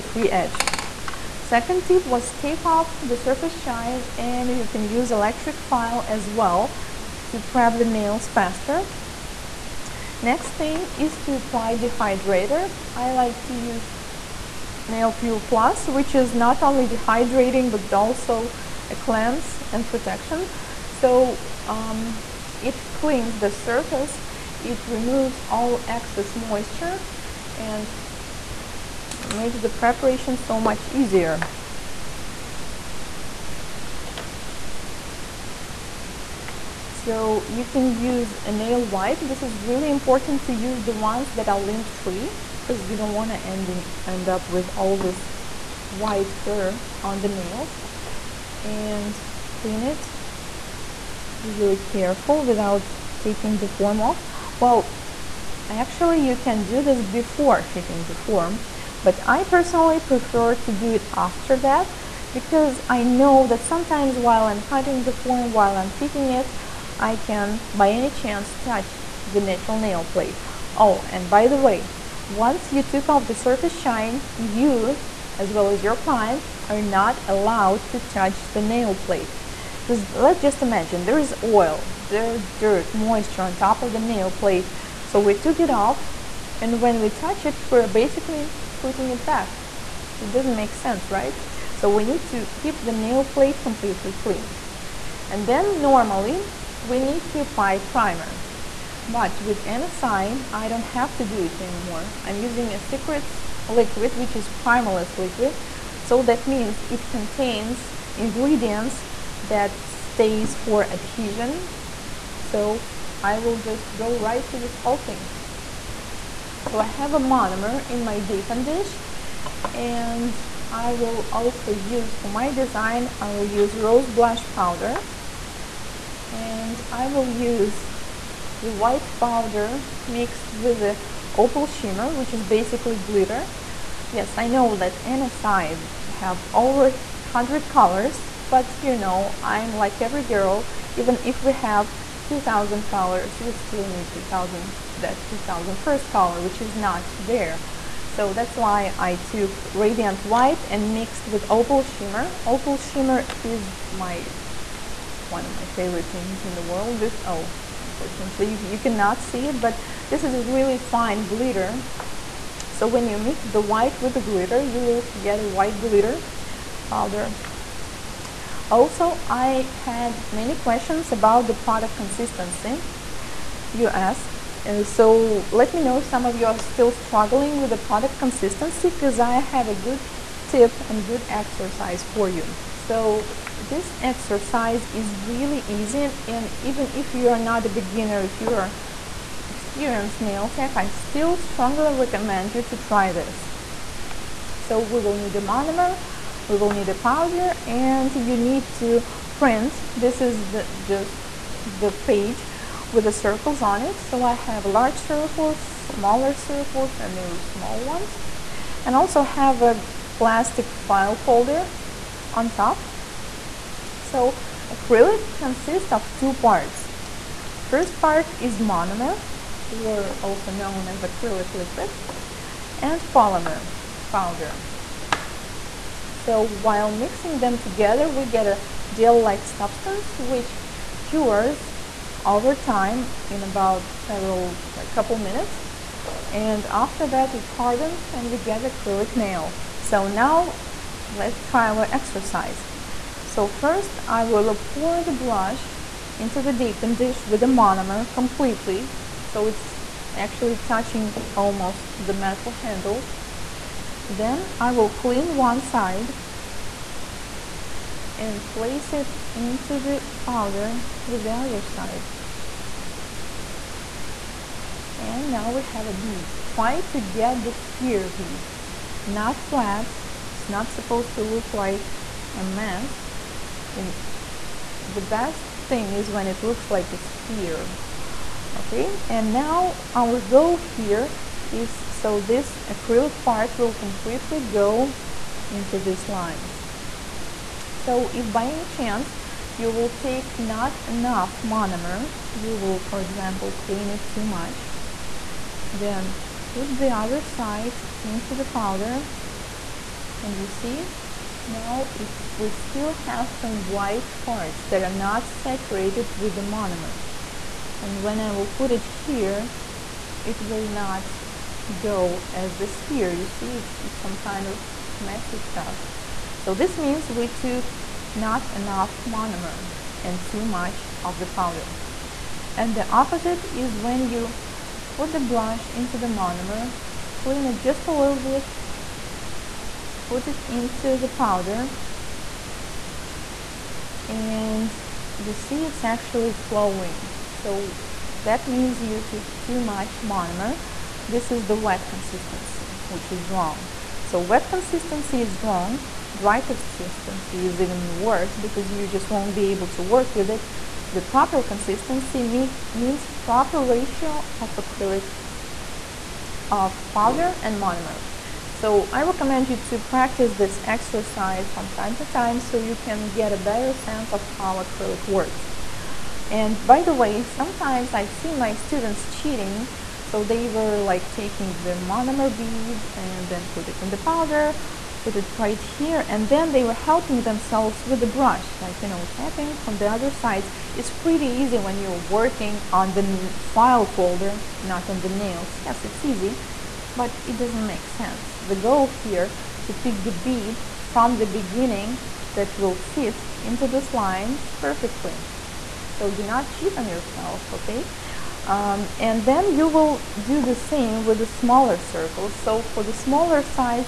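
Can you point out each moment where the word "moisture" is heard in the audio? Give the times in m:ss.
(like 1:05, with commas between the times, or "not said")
0:26, 1:22.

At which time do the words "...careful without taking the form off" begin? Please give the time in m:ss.
0:51.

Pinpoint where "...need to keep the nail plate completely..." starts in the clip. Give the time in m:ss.
1:32.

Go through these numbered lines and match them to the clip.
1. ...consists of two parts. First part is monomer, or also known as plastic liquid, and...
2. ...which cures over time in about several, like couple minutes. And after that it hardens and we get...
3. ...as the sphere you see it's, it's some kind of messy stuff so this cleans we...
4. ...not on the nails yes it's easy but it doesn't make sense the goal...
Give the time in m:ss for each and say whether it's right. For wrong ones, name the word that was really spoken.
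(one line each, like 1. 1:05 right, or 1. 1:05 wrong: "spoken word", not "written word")
1. 3:35 wrong: "acrylic", not "plastic"
2. 3:50 right
3. 5:12 wrong: "means", not "cleans"
4. 6:24 right.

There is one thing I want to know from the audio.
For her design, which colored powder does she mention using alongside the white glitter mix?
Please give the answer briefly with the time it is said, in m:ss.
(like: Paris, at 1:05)
Rose blush, at 2:03.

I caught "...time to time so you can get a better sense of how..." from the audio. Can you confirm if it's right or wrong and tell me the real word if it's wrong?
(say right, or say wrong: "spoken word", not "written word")
right.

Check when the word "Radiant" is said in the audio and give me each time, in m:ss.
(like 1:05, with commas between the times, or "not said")
2:29.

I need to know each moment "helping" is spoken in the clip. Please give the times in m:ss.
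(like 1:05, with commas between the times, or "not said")
6:16.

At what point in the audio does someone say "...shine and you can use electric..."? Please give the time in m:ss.
0:03.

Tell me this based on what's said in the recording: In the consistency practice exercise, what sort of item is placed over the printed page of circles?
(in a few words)
Plastic file folder.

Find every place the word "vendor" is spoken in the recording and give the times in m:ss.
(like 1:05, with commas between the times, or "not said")
not said.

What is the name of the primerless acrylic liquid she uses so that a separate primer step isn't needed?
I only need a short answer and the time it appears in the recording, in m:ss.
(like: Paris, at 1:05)
Secrets, at 1:42.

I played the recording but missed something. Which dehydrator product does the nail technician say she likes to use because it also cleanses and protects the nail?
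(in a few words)
Nail Pure Plus.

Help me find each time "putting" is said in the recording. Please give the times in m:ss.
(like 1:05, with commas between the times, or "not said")
1:28.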